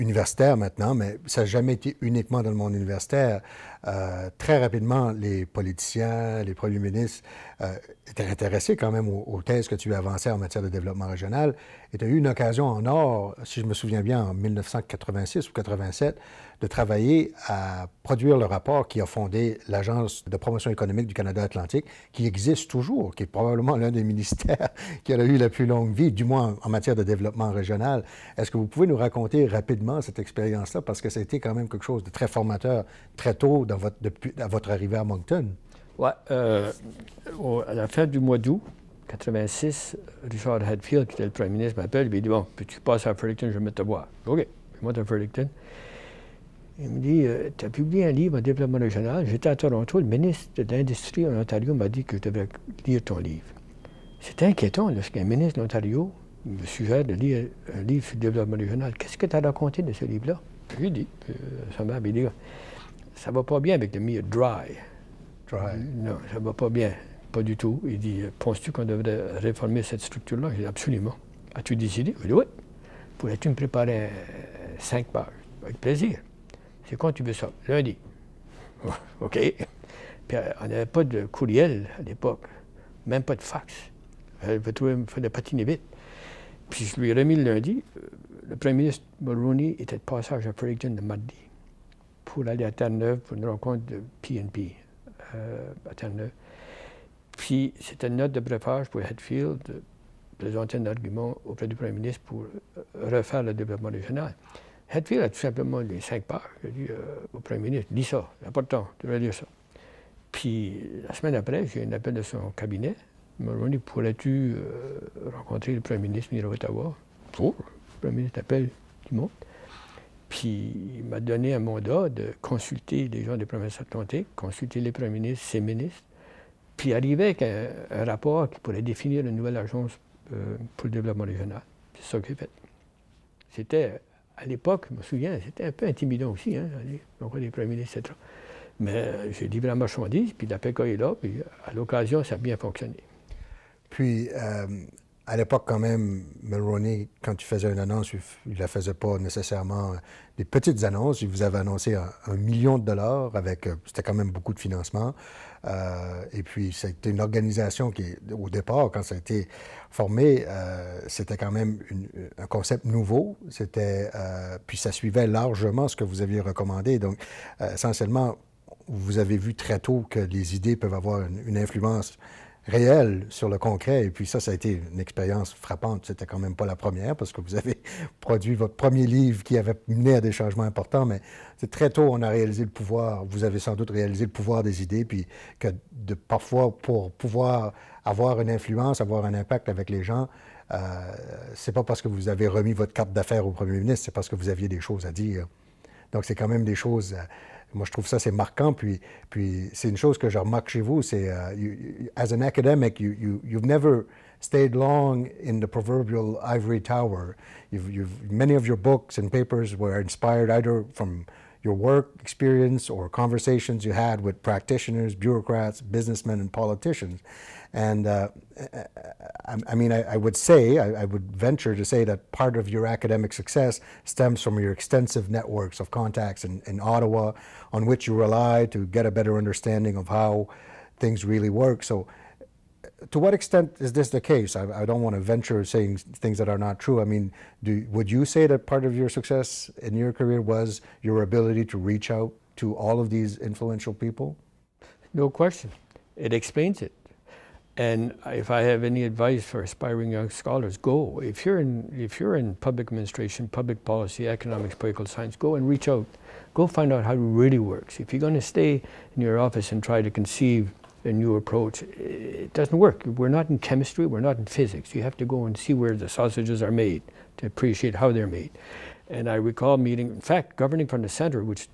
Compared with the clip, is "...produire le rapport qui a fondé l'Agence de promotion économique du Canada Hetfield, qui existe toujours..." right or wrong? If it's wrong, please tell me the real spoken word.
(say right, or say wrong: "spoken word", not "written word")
wrong: "Atlantique", not "Hetfield".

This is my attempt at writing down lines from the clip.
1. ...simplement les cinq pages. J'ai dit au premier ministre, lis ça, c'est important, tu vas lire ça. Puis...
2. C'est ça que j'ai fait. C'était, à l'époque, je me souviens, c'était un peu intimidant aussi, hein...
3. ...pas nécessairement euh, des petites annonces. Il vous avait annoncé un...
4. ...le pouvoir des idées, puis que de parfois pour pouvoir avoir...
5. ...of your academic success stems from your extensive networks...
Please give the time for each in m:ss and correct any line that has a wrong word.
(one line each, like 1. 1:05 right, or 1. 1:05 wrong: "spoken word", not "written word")
1. 1:45 right
2. 2:11 right
3. 2:28 right
4. 3:04 right
5. 3:42 right.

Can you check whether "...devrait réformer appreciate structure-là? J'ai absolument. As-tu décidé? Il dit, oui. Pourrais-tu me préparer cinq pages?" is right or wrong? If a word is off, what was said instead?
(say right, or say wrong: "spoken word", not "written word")
wrong: "cette", not "appreciate".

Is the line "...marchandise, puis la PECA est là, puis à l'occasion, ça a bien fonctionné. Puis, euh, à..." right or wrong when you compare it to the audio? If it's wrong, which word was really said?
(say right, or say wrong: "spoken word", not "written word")
right.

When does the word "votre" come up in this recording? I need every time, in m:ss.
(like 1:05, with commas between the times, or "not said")
0:34, 2:58, 3:12.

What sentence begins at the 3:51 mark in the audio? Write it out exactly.
So, to what extent is this the case?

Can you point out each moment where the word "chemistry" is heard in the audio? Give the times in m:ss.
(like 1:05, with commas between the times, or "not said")
4:23.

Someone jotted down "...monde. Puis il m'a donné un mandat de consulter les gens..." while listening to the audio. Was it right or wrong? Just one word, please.
right.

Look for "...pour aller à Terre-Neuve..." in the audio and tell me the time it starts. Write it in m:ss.
1:32.